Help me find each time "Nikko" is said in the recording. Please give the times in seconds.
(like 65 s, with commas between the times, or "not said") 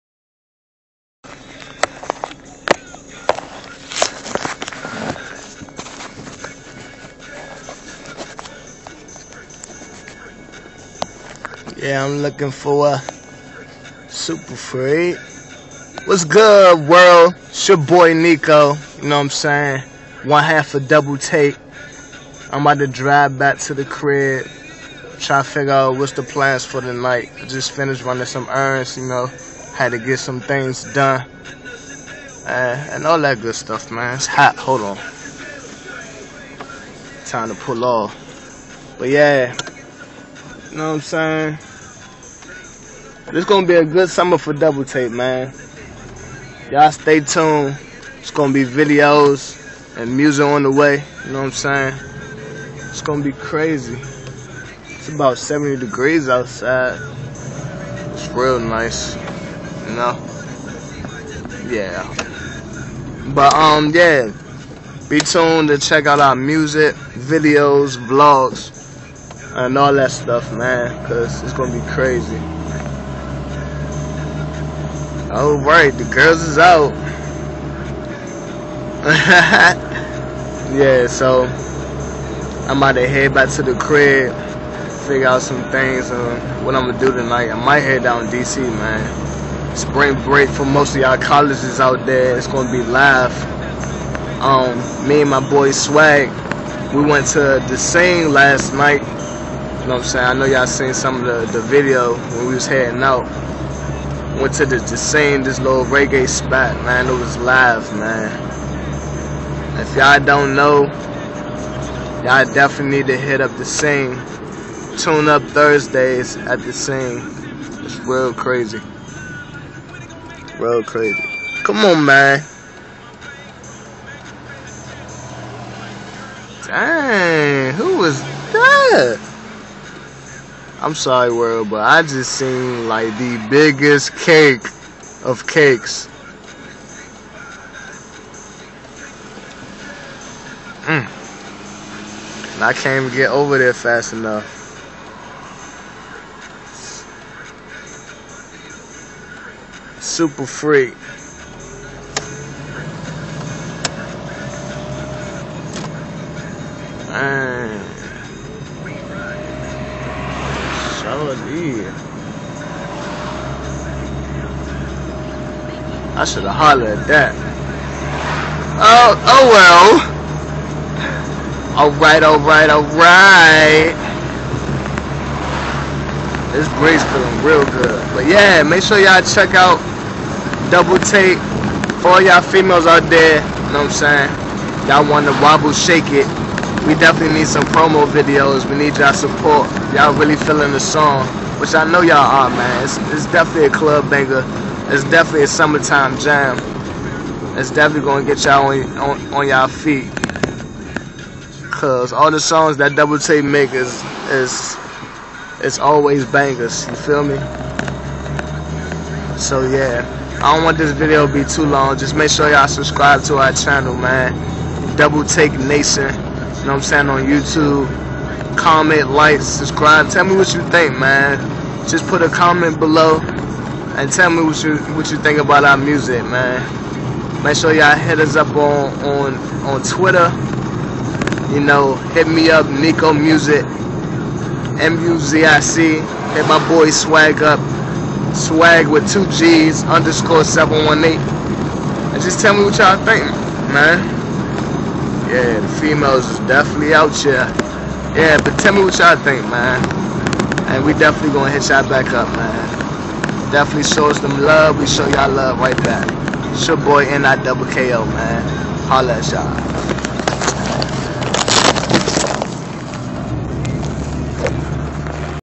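18 s, 232 s.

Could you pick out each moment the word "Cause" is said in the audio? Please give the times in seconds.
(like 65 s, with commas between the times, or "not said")
71 s, 201 s.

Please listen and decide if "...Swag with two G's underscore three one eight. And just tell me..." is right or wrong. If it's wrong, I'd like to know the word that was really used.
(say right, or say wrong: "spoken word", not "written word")
wrong: "seven", not "three".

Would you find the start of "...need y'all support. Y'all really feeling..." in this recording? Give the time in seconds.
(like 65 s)
188 s.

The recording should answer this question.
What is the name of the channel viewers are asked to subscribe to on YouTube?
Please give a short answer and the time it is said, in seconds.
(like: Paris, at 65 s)
Double Take Nation, at 214 s.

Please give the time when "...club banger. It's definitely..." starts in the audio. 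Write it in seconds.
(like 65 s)
193 s.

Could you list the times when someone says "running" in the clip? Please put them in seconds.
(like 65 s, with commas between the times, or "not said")
28 s.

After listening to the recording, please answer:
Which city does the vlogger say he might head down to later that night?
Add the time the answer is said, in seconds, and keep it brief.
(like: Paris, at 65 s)
DC, at 88 s.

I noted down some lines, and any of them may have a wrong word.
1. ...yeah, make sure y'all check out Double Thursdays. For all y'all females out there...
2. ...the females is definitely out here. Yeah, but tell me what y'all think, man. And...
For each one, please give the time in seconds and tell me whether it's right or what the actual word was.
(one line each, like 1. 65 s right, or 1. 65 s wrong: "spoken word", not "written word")
1. 178 s wrong: "Take", not "Thursdays"
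2. 245 s right.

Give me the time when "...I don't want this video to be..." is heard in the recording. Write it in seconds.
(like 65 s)
210 s.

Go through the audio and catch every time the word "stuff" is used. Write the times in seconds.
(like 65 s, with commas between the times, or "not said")
33 s, 70 s.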